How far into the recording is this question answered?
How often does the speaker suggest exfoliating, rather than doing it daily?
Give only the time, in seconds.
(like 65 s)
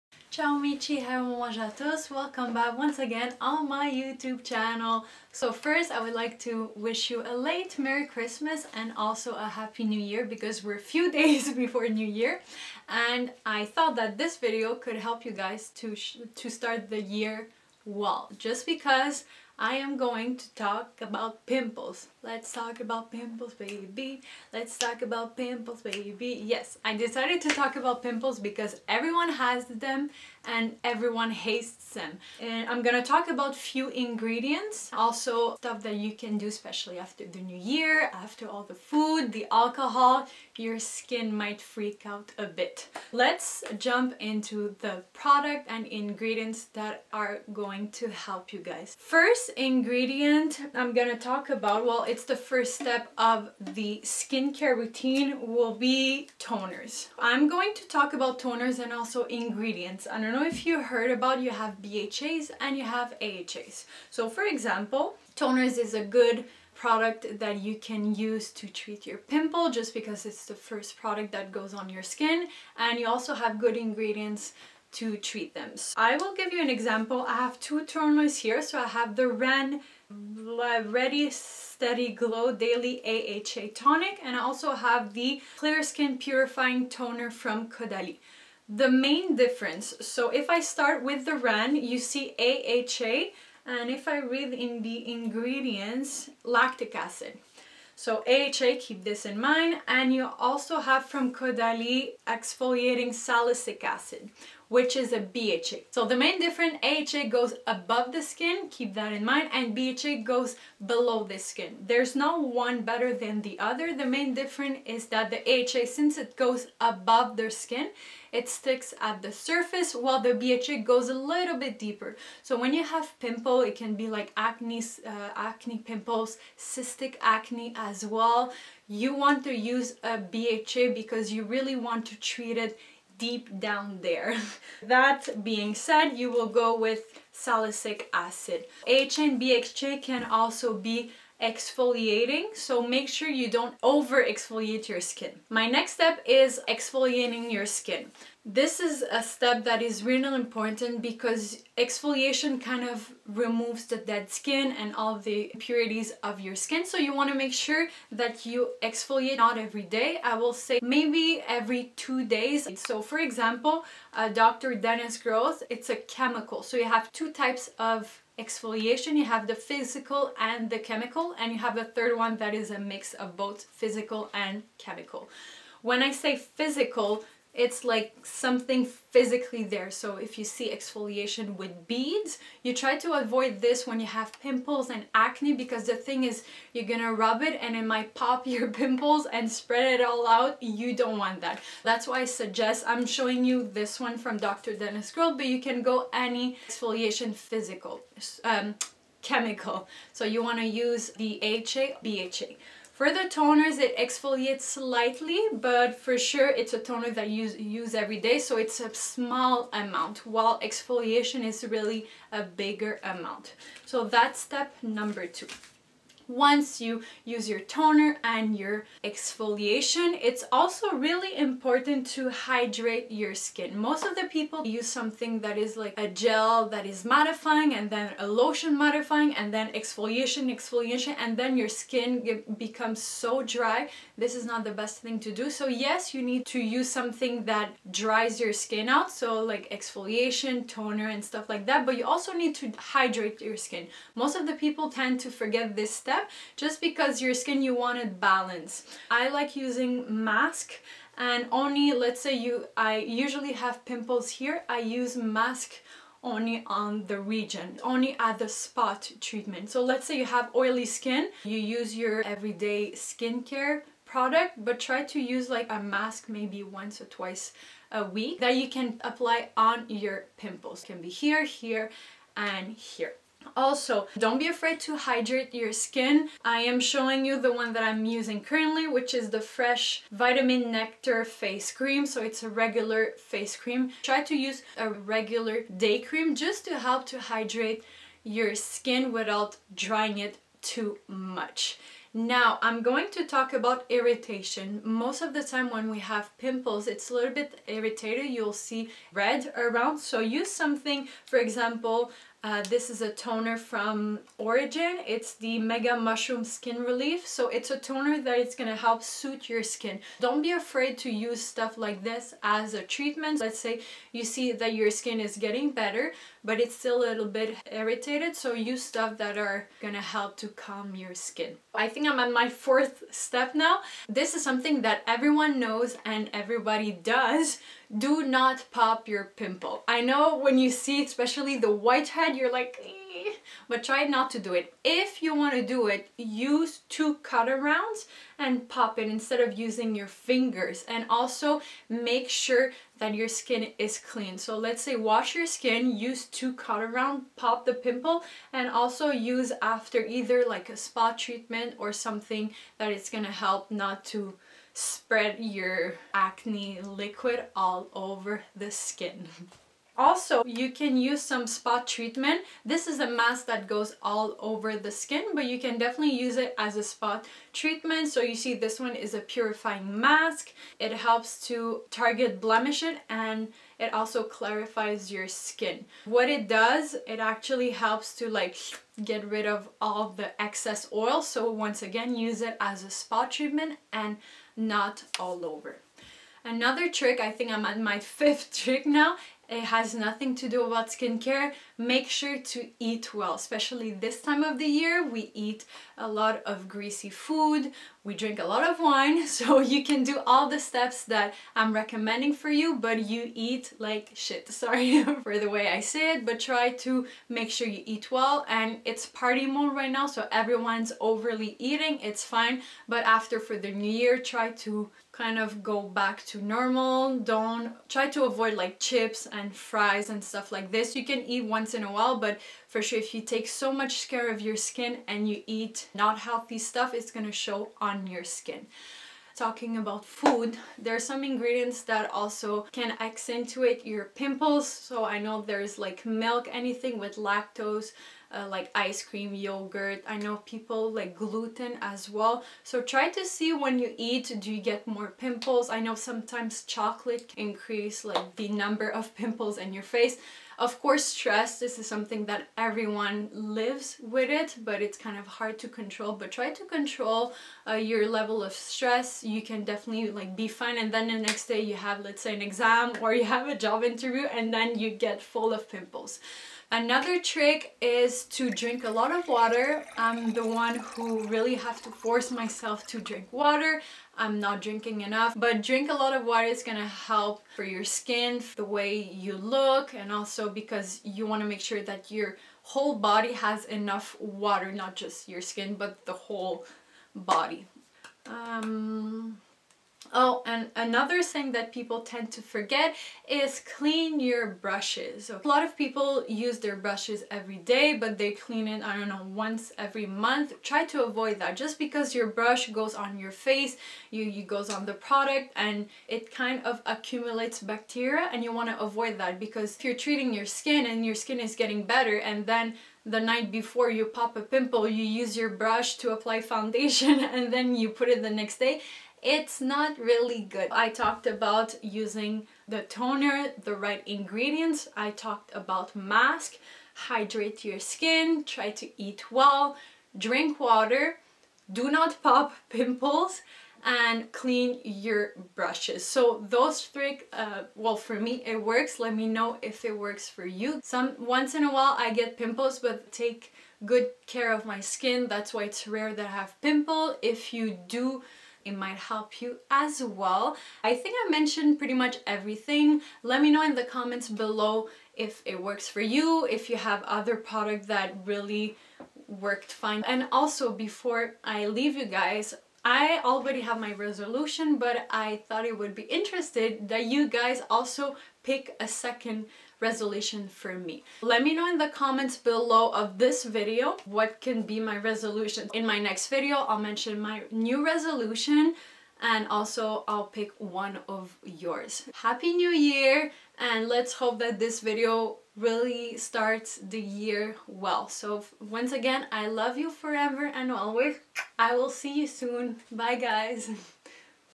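161 s.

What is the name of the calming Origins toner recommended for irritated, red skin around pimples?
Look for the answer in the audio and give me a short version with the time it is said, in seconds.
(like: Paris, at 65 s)
Mega Mushroom Skin Relief, at 305 s.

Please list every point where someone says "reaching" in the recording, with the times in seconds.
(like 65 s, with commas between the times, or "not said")
not said.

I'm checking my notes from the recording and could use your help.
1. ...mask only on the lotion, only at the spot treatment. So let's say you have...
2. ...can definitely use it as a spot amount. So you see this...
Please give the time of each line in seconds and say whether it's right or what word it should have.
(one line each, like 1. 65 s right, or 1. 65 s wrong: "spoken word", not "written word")
1. 255 s wrong: "region", not "lotion"
2. 365 s wrong: "treatment", not "amount".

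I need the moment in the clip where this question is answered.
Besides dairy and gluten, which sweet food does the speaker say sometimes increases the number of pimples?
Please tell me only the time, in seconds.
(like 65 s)
446 s.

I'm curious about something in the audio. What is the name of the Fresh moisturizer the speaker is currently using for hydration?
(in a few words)
Vitamin Nectar Face Cream.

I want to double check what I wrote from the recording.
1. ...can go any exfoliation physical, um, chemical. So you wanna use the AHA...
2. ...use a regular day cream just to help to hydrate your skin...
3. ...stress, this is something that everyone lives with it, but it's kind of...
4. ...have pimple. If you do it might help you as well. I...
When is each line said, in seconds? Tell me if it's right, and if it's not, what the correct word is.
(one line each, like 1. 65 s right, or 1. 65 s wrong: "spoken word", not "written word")
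1. 195 s right
2. 284 s right
3. 451 s right
4. 546 s right.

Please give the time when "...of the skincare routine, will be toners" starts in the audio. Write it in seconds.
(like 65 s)
53 s.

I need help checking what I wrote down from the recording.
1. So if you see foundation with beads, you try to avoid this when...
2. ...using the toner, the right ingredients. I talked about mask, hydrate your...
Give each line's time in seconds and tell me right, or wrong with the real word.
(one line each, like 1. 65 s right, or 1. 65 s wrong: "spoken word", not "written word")
1. 179 s wrong: "exfoliation", not "foundation"
2. 521 s right.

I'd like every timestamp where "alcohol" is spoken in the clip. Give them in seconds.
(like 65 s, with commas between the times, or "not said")
39 s.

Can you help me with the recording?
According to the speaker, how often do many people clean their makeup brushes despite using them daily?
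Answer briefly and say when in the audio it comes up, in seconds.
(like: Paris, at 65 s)
once every month, at 499 s.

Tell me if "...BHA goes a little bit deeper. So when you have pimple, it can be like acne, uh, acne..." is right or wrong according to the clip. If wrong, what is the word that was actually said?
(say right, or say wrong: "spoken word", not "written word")
right.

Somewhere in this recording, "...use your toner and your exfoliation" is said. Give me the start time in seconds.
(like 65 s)
217 s.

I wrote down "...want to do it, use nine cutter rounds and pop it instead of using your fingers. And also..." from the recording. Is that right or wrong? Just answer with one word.
wrong.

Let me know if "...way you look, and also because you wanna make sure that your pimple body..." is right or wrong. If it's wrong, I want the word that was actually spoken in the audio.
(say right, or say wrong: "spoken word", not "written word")
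wrong: "whole", not "pimple".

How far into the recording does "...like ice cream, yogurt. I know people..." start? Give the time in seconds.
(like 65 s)
438 s.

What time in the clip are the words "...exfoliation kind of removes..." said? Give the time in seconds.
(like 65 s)
151 s.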